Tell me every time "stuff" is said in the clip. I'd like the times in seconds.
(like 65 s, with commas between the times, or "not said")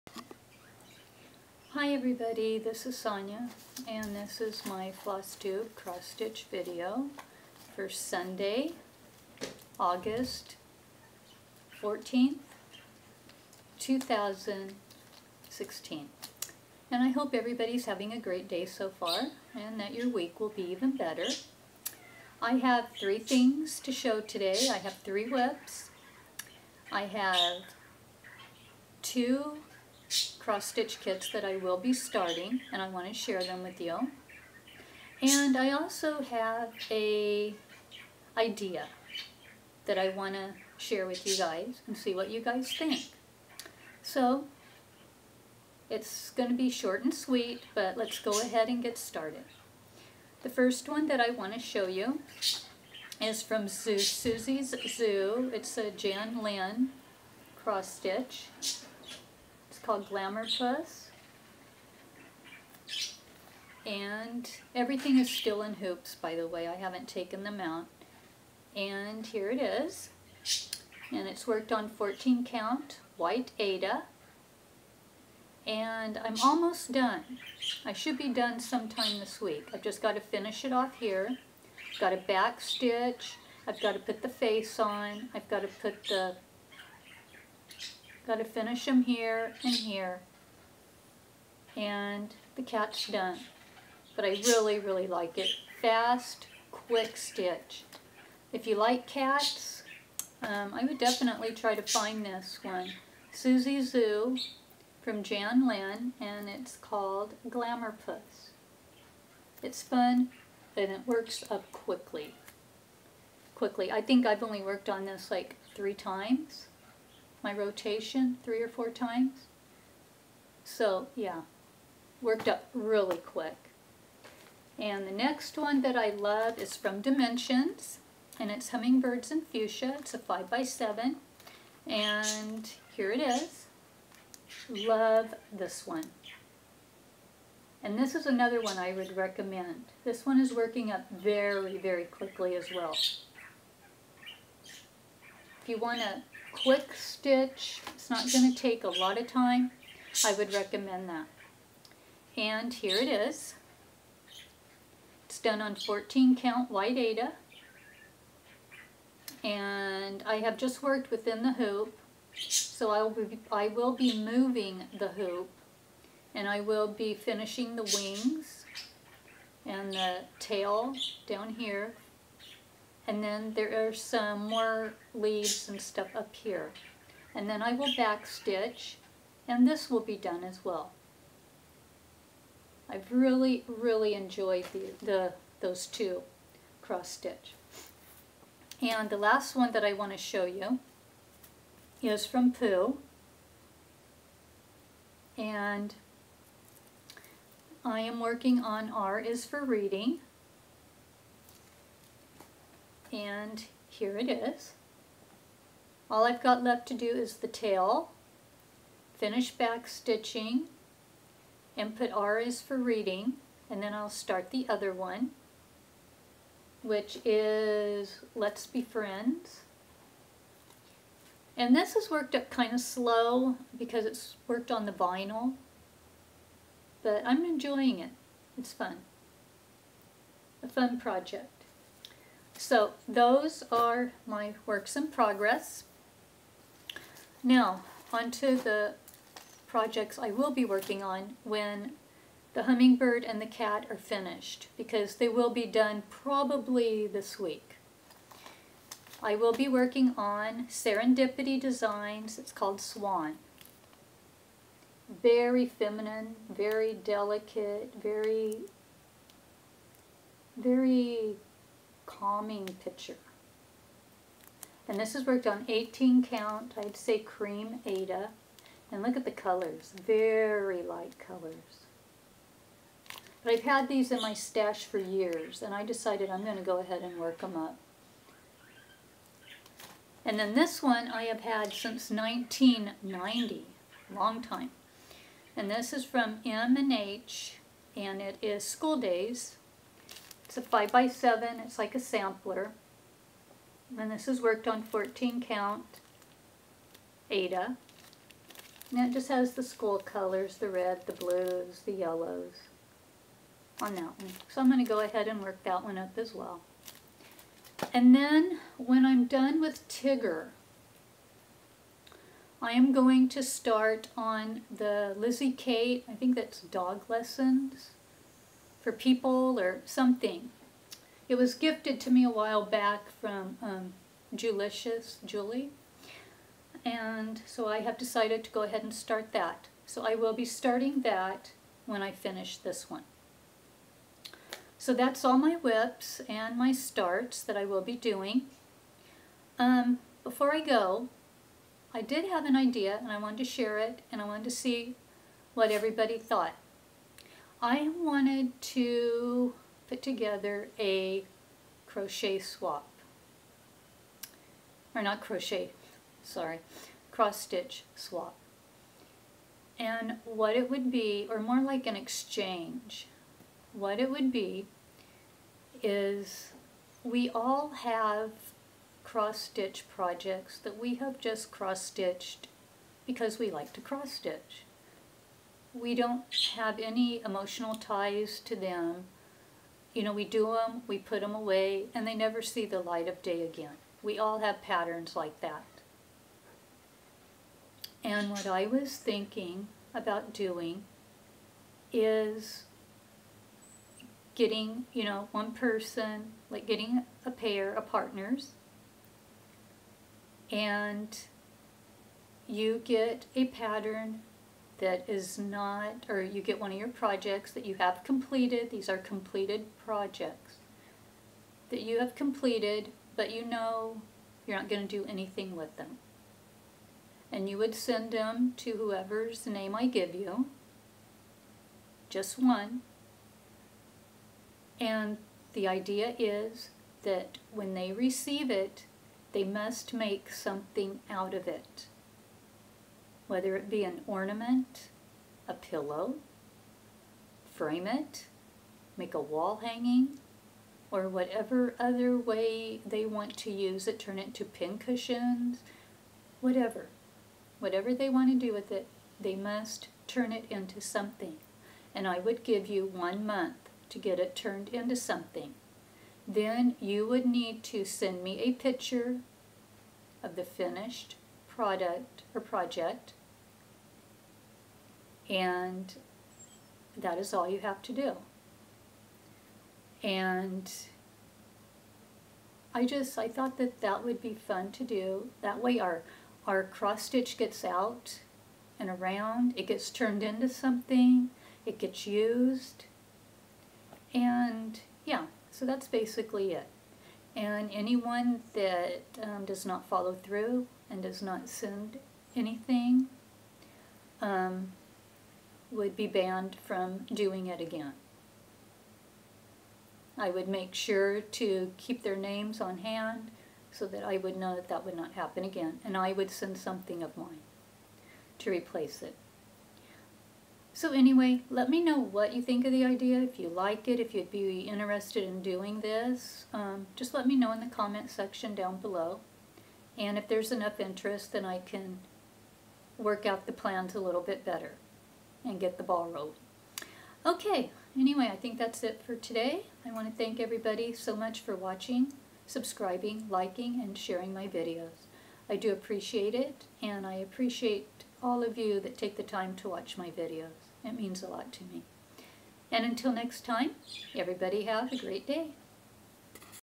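175 s.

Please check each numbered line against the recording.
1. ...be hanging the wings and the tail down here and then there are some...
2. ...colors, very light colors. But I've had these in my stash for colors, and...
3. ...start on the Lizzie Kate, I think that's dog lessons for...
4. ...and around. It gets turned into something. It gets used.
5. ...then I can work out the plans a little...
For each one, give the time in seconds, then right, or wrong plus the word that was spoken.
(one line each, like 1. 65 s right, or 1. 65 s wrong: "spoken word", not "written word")
1. 166 s wrong: "finishing", not "hanging"
2. 269 s wrong: "years", not "colors"
3. 313 s right
4. 478 s right
5. 521 s right.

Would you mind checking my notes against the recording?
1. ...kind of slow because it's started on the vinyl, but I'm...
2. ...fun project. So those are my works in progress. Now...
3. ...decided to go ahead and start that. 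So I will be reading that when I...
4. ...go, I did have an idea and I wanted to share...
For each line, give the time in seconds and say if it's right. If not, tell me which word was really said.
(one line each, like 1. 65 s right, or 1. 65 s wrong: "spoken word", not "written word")
1. 222 s wrong: "worked", not "started"
2. 230 s right
3. 327 s wrong: "starting", not "reading"
4. 340 s right.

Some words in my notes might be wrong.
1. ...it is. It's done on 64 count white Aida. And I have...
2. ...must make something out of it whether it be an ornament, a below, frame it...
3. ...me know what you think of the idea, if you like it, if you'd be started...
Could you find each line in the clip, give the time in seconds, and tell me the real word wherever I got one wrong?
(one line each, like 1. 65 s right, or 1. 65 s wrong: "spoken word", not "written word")
1. 152 s wrong: "14", not "64"
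2. 429 s wrong: "pillow", not "below"
3. 511 s wrong: "interested", not "started".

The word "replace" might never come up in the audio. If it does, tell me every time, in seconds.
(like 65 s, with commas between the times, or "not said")
508 s.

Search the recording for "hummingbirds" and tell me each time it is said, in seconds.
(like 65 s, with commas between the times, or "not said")
128 s, 242 s.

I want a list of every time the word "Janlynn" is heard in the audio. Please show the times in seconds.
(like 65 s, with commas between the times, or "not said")
55 s, 105 s.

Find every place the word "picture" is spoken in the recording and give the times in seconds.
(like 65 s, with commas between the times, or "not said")
262 s, 458 s.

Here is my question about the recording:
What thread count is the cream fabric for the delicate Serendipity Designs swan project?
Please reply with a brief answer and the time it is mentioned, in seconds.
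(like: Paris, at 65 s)
18, at 265 s.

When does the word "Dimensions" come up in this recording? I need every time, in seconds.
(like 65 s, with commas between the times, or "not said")
127 s.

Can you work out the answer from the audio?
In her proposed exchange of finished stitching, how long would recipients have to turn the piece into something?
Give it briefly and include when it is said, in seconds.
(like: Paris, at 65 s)
1 month, at 452 s.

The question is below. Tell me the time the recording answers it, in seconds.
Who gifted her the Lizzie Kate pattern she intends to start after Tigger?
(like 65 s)
324 s.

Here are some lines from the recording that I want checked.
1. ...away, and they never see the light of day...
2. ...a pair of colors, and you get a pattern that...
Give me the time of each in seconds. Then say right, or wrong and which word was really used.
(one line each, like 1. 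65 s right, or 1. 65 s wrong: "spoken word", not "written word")
1. 381 s right
2. 397 s wrong: "partners", not "colors".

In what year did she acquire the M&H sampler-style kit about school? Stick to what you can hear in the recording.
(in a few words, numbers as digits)
1990.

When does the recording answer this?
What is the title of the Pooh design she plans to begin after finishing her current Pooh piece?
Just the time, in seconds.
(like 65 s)
218 s.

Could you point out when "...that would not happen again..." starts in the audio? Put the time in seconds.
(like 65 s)
504 s.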